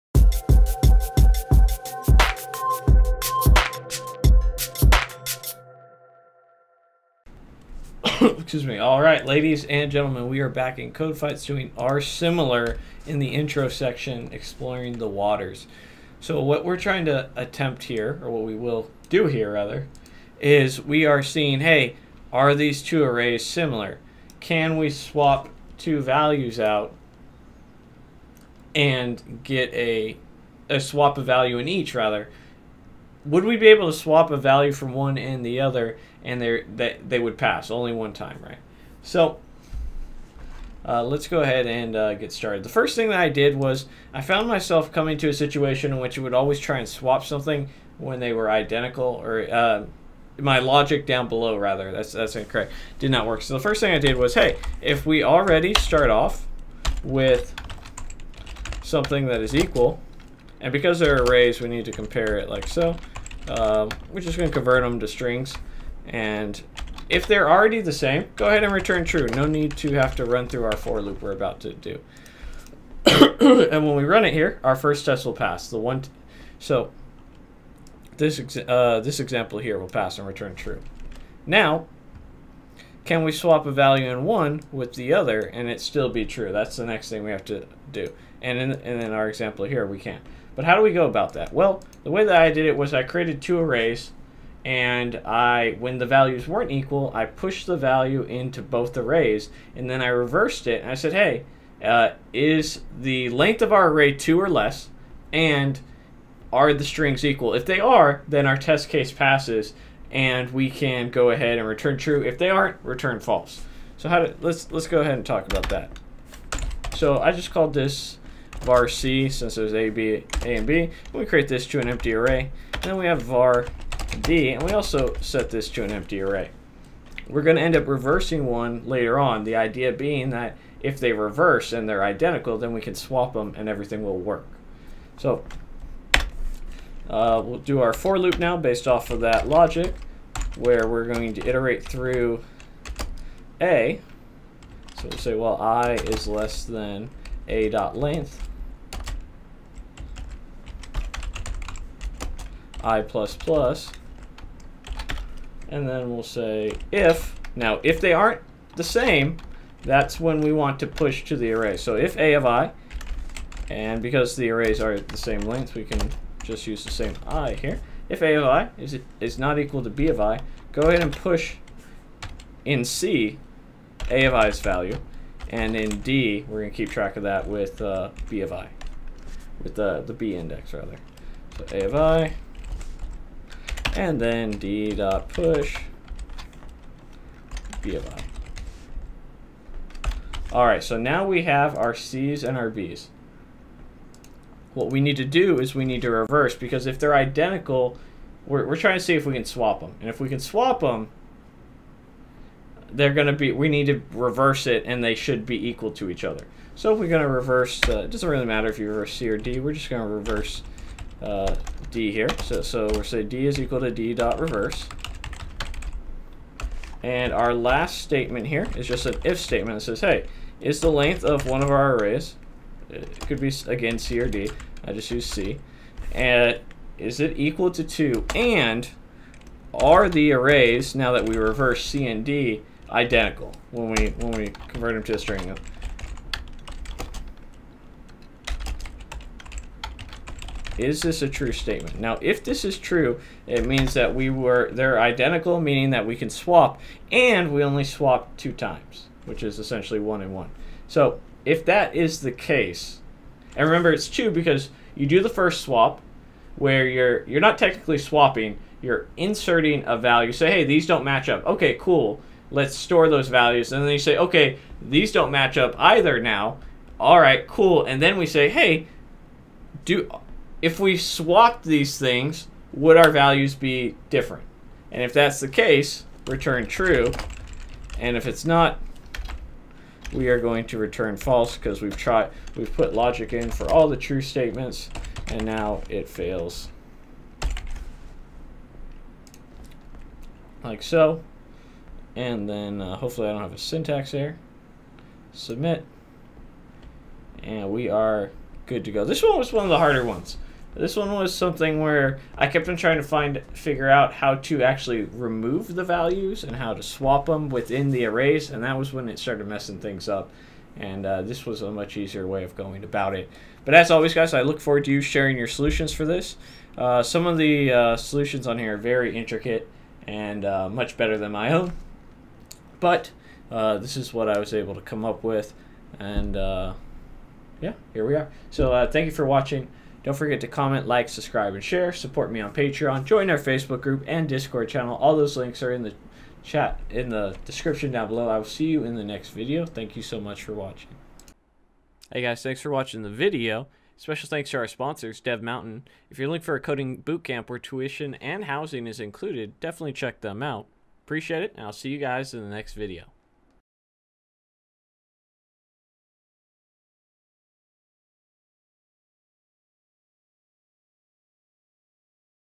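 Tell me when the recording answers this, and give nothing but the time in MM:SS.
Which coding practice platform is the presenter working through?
00:10.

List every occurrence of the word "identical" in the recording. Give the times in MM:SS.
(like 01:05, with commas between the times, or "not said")
00:48, 02:12, 03:17, 03:52, 04:04.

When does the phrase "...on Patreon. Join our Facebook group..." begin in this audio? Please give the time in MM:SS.
05:32.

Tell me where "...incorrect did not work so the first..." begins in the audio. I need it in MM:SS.
00:52.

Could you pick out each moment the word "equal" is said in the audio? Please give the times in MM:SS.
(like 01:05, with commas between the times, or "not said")
00:59, 01:36, 01:47, 02:49, 03:25, 03:33, 03:47.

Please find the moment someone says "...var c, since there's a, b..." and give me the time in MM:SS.
01:58.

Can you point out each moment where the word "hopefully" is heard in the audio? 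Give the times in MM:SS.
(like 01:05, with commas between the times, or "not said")
04:52.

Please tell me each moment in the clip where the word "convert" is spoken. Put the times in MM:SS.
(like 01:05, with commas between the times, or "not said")
01:04, 03:54.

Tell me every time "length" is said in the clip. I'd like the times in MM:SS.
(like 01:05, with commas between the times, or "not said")
01:43, 02:27, 02:45, 03:40.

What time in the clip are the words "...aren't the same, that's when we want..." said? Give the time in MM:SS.
02:38.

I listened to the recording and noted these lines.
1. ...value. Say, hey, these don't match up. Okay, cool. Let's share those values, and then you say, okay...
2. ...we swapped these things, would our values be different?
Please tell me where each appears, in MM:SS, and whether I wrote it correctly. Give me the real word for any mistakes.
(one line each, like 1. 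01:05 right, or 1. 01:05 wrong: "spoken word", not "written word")
1. 04:19 wrong: "store", not "share"
2. 04:30 right.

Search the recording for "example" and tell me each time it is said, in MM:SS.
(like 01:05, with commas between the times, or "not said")
01:19, 01:29.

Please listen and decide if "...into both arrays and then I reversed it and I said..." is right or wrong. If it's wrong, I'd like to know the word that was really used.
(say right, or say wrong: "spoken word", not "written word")
right.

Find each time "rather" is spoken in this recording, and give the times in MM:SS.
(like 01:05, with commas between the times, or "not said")
00:19, 00:31, 00:51, 03:00.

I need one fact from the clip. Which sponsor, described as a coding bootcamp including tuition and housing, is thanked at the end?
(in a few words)
Dev Mountain.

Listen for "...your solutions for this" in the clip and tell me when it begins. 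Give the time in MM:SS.
05:15.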